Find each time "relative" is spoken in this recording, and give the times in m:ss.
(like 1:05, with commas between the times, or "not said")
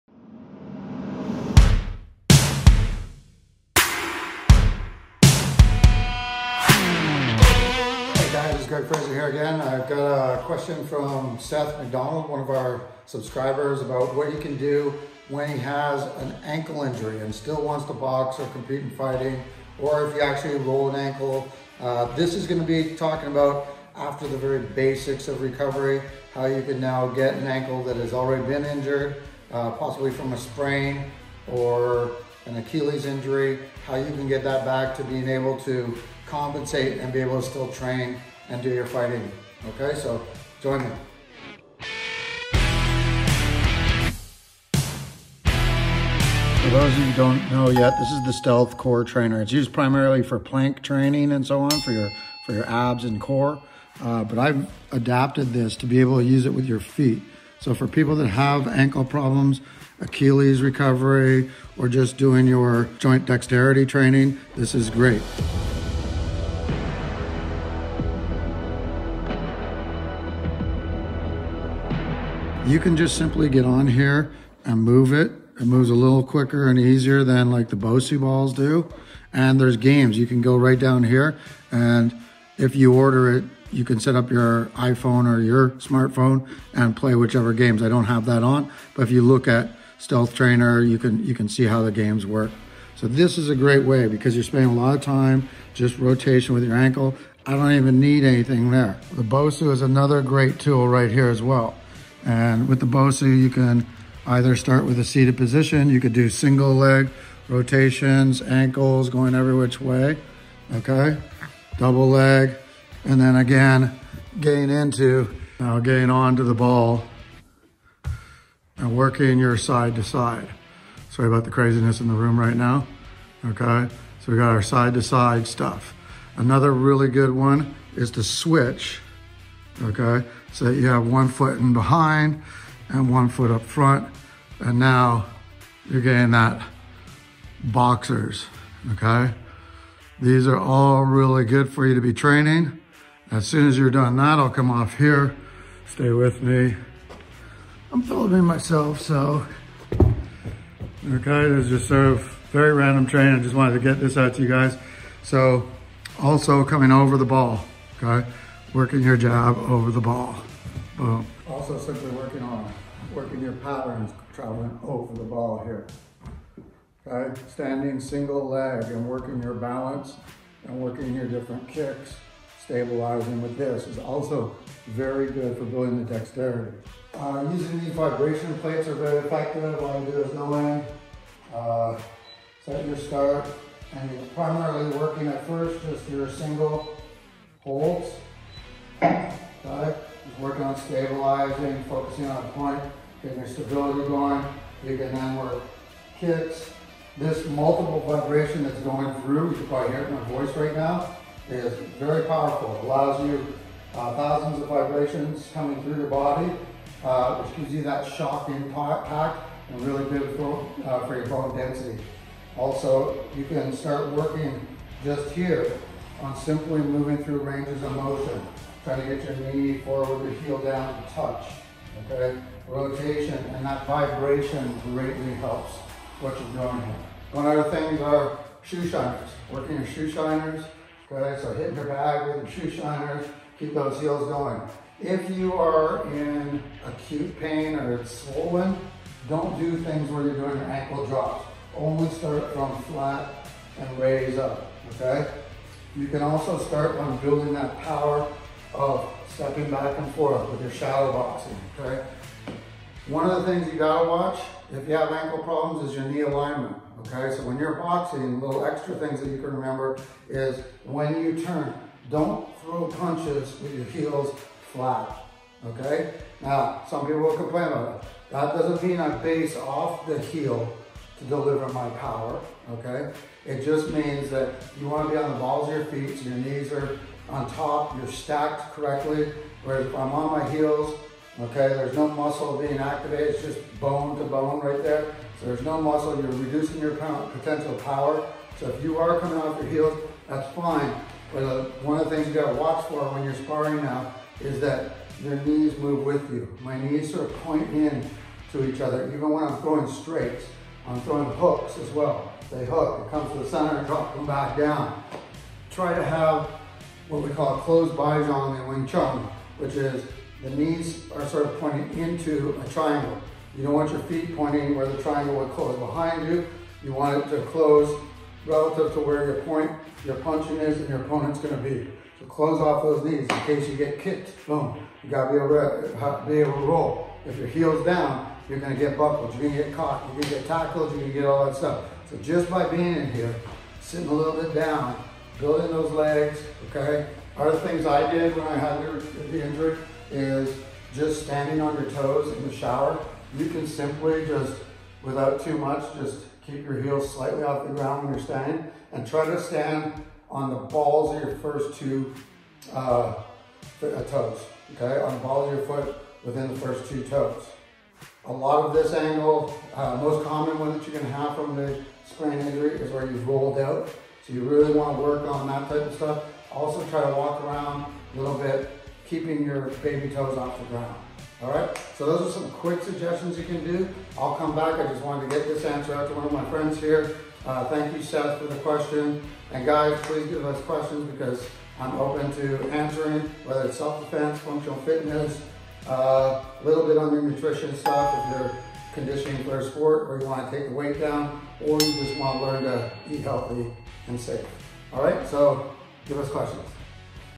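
5:18.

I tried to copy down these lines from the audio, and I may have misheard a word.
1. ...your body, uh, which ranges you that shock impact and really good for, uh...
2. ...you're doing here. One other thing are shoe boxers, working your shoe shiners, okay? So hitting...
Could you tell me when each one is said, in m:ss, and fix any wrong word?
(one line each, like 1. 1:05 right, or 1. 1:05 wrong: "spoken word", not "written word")
1. 3:25 wrong: "gives", not "ranges"
2. 3:46 wrong: "shiners", not "boxers".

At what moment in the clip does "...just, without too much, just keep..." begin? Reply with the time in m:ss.
5:44.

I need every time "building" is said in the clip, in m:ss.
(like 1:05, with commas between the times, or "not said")
2:55, 4:07, 5:35.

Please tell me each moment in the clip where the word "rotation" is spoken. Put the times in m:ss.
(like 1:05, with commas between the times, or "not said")
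1:35, 1:47, 3:42.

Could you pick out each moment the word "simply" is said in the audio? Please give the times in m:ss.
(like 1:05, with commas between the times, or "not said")
1:13, 2:41, 3:36, 5:43.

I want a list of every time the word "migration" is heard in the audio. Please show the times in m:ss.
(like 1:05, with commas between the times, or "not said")
not said.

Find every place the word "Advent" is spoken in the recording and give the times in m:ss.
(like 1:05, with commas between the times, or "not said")
not said.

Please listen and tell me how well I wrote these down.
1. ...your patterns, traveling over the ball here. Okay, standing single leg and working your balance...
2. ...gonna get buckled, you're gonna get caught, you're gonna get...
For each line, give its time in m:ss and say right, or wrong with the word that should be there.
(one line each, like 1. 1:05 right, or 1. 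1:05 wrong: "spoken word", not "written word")
1. 2:43 right
2. 5:28 right.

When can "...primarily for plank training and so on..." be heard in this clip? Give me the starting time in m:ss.
0:49.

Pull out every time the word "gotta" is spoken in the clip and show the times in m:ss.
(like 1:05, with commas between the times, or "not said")
4:13, 4:52, 5:25.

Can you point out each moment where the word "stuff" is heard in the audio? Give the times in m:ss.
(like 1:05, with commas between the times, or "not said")
2:05, 5:31, 6:05, 6:27.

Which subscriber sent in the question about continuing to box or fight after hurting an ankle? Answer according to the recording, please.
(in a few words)
Seth McDonald.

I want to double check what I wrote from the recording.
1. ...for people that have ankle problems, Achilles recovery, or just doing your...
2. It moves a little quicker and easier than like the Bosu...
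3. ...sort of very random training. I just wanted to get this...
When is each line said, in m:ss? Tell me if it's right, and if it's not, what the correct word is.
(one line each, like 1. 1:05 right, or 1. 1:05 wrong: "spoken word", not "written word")
1. 0:57 right
2. 1:15 right
3. 2:31 right.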